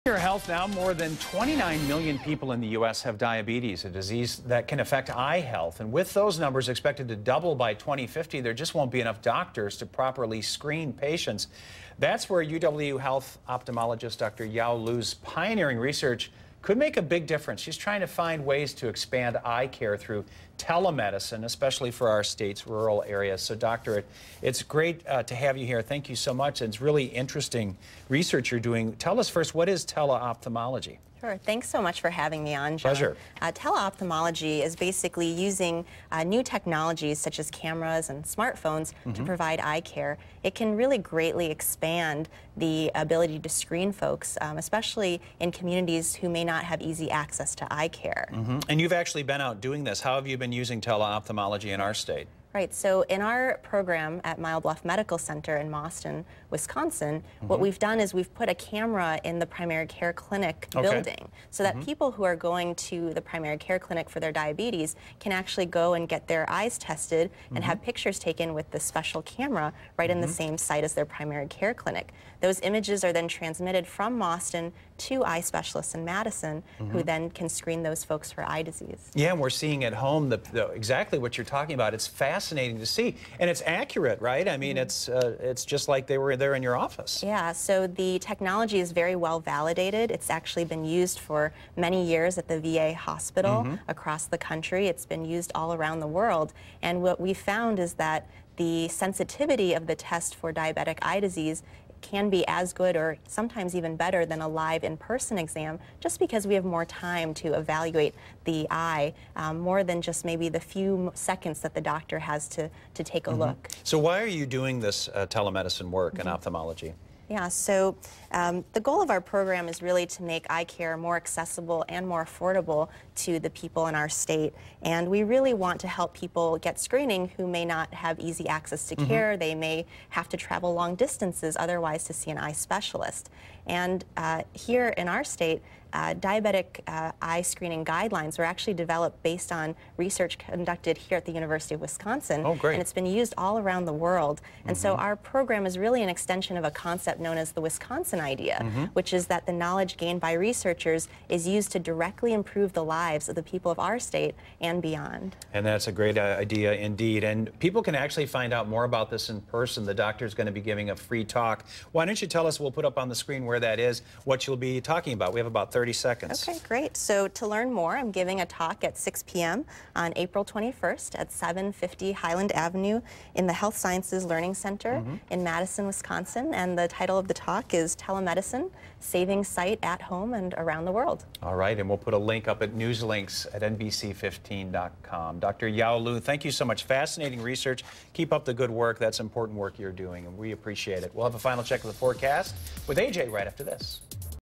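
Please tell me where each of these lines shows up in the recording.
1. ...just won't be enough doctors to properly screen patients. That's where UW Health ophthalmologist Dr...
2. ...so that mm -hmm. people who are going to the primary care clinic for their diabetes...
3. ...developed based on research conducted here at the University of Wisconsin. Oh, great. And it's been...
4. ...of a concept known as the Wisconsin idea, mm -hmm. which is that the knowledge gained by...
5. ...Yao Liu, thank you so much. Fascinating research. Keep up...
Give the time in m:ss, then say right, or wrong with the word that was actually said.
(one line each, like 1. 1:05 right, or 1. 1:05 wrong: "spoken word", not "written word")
1. 0:08 right
2. 1:01 right
3. 2:18 right
4. 2:26 right
5. 3:05 right.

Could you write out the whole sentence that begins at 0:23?
So, Doctor, it's great uh, to have you here.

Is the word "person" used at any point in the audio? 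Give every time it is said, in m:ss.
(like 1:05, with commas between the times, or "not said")
1:44, 2:39.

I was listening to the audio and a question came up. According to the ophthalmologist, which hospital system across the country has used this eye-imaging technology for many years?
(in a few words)
The VA hospital.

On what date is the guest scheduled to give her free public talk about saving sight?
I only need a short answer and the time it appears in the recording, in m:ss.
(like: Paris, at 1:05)
April 21, at 2:50.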